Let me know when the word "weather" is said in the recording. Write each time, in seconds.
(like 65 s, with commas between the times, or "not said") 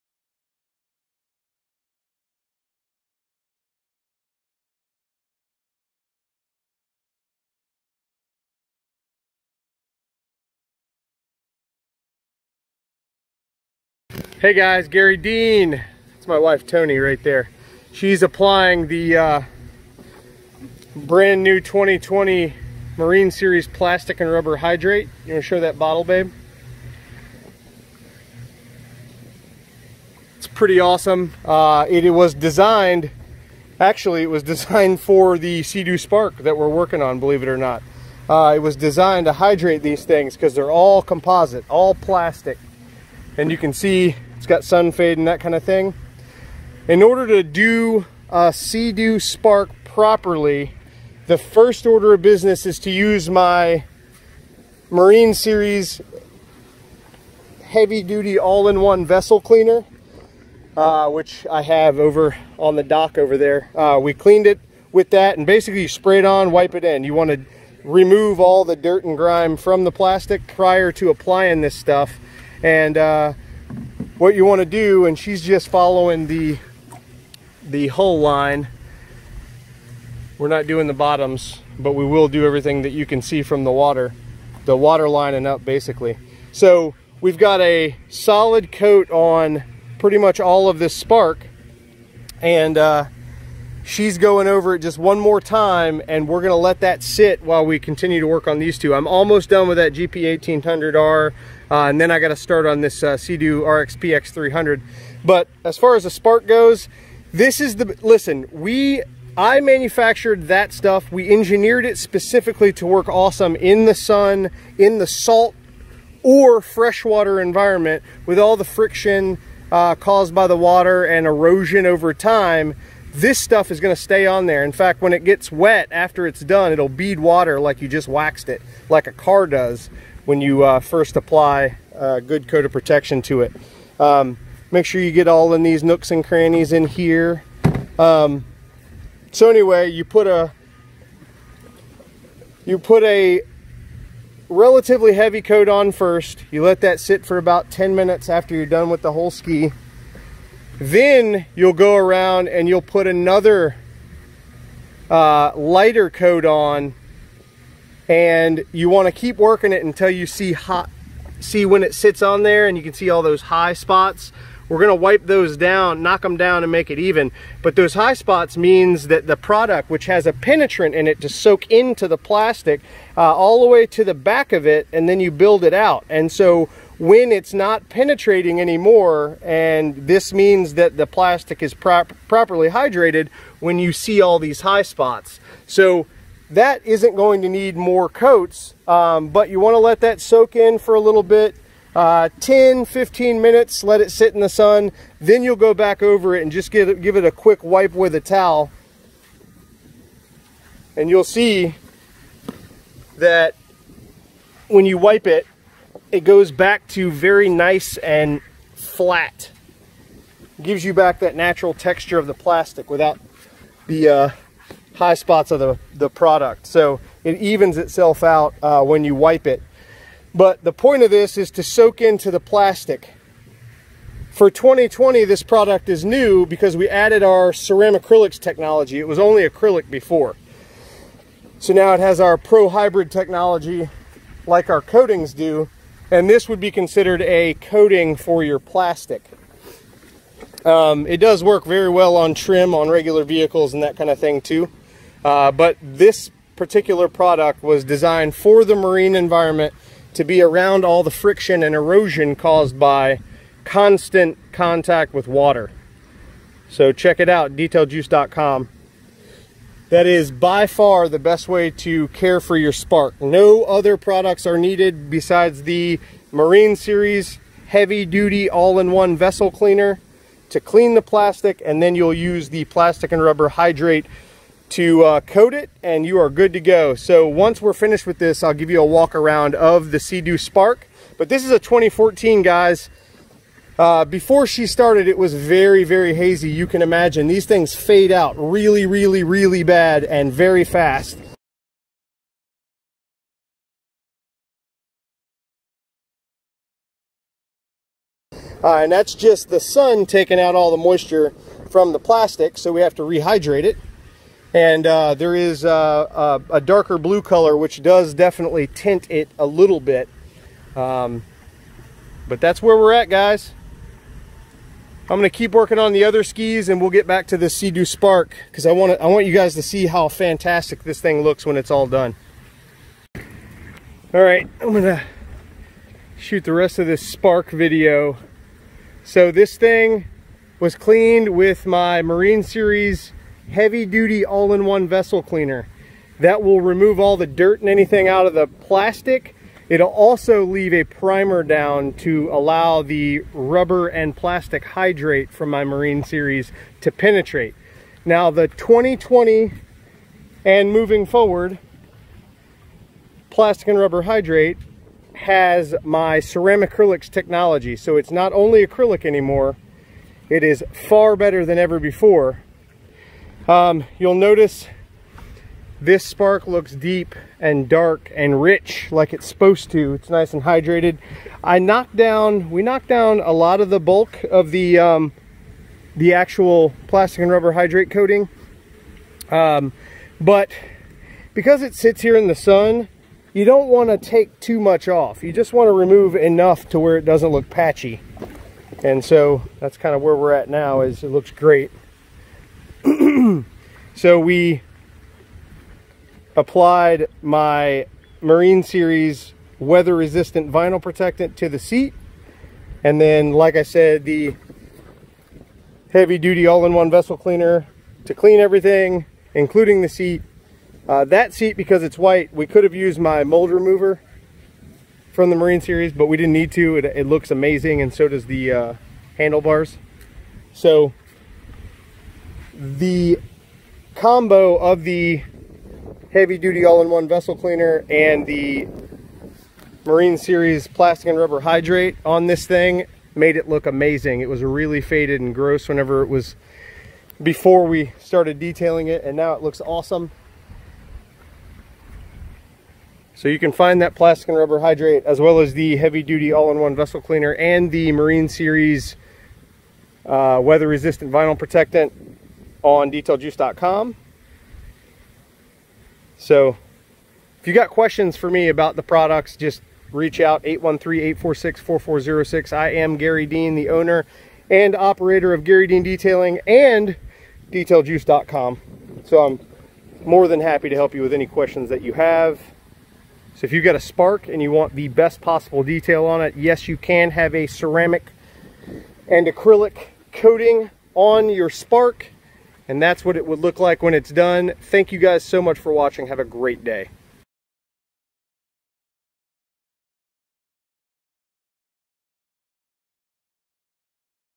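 399 s, 450 s.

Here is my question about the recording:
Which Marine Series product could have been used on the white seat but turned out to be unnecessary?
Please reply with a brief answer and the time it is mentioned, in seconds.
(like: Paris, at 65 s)
mold remover, at 413 s.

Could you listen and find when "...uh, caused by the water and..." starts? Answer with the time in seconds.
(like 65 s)
119 s.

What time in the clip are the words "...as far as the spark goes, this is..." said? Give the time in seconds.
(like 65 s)
105 s.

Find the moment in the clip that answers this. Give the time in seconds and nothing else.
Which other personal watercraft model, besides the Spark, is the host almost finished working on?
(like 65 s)
99 s.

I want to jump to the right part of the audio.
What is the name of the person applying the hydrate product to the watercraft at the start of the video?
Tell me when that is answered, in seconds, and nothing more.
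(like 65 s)
16 s.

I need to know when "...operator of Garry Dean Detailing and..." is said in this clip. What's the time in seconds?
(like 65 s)
464 s.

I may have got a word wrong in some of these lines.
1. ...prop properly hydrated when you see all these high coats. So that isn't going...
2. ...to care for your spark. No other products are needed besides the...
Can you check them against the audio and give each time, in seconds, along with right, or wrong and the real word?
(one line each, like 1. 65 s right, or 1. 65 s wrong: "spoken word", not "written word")
1. 181 s wrong: "spots", not "coats"
2. 261 s right.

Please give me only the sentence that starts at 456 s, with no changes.
So if you got questions for me about the products, just reach out 813-846-4406.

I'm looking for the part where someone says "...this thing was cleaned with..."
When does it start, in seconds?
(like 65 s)
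329 s.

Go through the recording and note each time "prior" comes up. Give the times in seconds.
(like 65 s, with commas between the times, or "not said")
70 s.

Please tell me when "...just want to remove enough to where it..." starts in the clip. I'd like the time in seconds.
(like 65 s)
385 s.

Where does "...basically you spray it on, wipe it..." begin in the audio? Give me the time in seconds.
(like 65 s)
65 s.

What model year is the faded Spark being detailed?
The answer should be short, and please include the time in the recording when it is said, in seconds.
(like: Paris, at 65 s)
2014, at 281 s.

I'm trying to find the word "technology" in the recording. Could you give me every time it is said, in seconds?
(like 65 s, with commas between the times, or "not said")
228 s, 233 s, 357 s.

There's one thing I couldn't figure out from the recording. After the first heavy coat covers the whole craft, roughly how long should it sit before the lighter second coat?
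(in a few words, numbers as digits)
10 minutes.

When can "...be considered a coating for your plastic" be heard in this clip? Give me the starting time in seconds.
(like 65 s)
236 s.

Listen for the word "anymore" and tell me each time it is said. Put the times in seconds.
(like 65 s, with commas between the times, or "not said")
178 s, 359 s.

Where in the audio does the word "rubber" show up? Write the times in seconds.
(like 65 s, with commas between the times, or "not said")
24 s, 273 s, 343 s, 353 s, 377 s, 431 s, 444 s.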